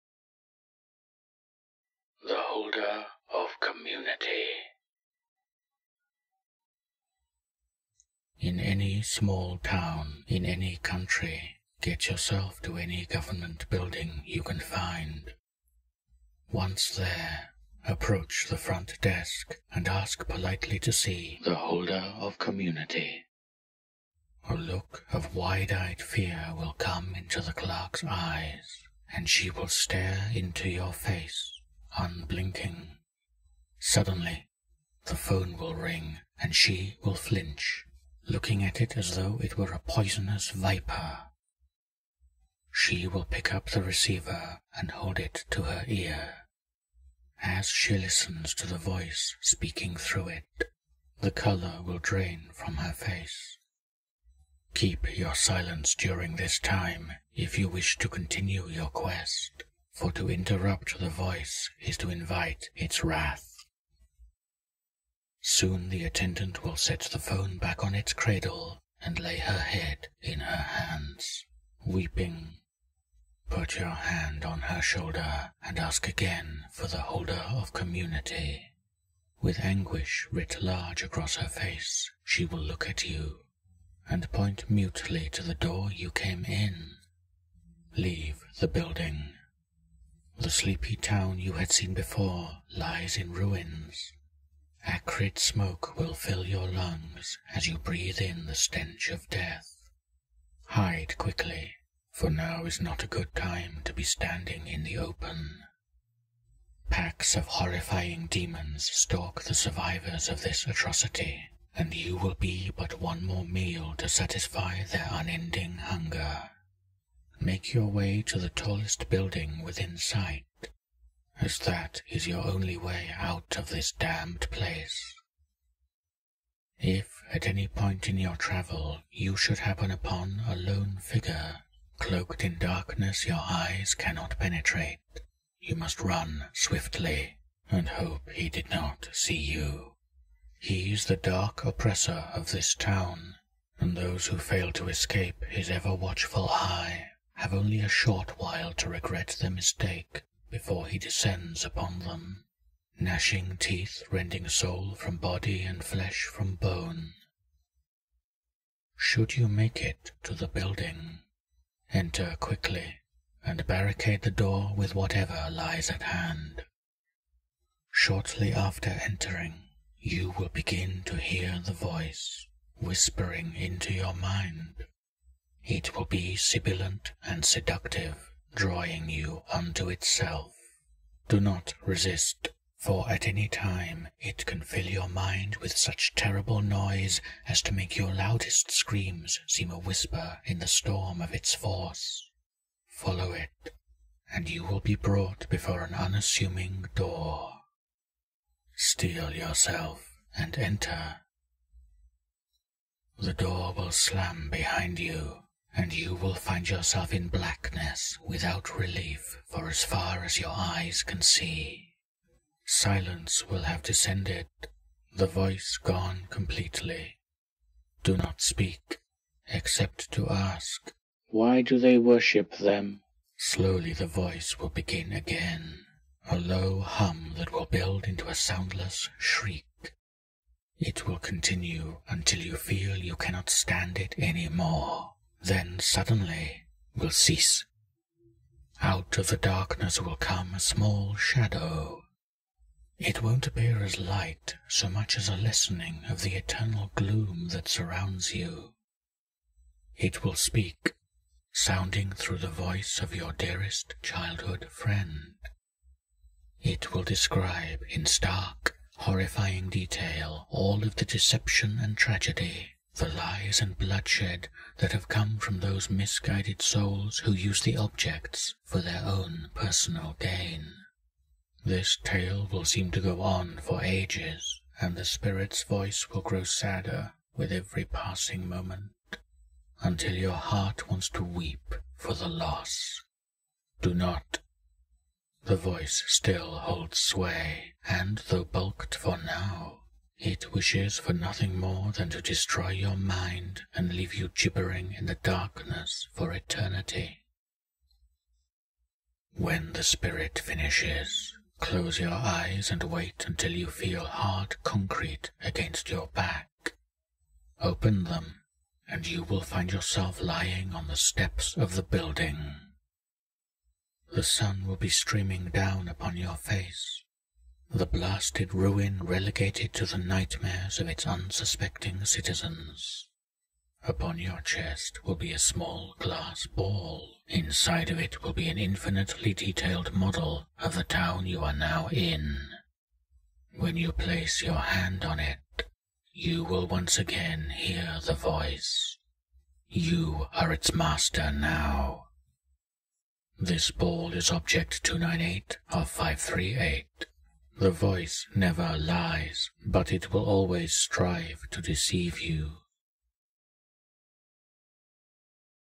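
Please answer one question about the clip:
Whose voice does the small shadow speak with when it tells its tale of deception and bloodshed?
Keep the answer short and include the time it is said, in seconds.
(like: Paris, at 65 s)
Your dearest childhood friend, at 253 s.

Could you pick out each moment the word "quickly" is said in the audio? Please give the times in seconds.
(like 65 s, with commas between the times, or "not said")
101 s, 162 s.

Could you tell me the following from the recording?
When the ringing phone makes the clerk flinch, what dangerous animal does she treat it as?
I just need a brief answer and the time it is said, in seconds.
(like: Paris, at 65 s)
Poisonous viper, at 39 s.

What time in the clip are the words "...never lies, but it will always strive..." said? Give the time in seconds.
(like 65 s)
348 s.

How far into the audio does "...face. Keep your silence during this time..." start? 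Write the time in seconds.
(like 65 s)
52 s.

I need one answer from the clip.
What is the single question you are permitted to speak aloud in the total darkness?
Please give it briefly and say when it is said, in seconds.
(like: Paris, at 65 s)
Why do they worship them?, at 221 s.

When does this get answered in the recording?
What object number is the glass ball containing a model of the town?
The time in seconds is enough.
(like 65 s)
344 s.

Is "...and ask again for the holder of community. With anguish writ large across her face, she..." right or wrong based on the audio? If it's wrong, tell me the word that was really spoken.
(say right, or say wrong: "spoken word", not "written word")
right.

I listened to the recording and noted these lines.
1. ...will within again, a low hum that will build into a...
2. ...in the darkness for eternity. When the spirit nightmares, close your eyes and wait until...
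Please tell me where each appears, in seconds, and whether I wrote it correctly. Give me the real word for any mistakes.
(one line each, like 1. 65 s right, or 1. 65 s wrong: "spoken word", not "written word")
1. 224 s wrong: "begin", not "within"
2. 294 s wrong: "finishes", not "nightmares".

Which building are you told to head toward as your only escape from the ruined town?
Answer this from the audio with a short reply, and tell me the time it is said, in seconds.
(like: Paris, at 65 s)
The tallest building, at 118 s.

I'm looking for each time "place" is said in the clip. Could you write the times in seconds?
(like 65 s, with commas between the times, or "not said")
124 s, 333 s.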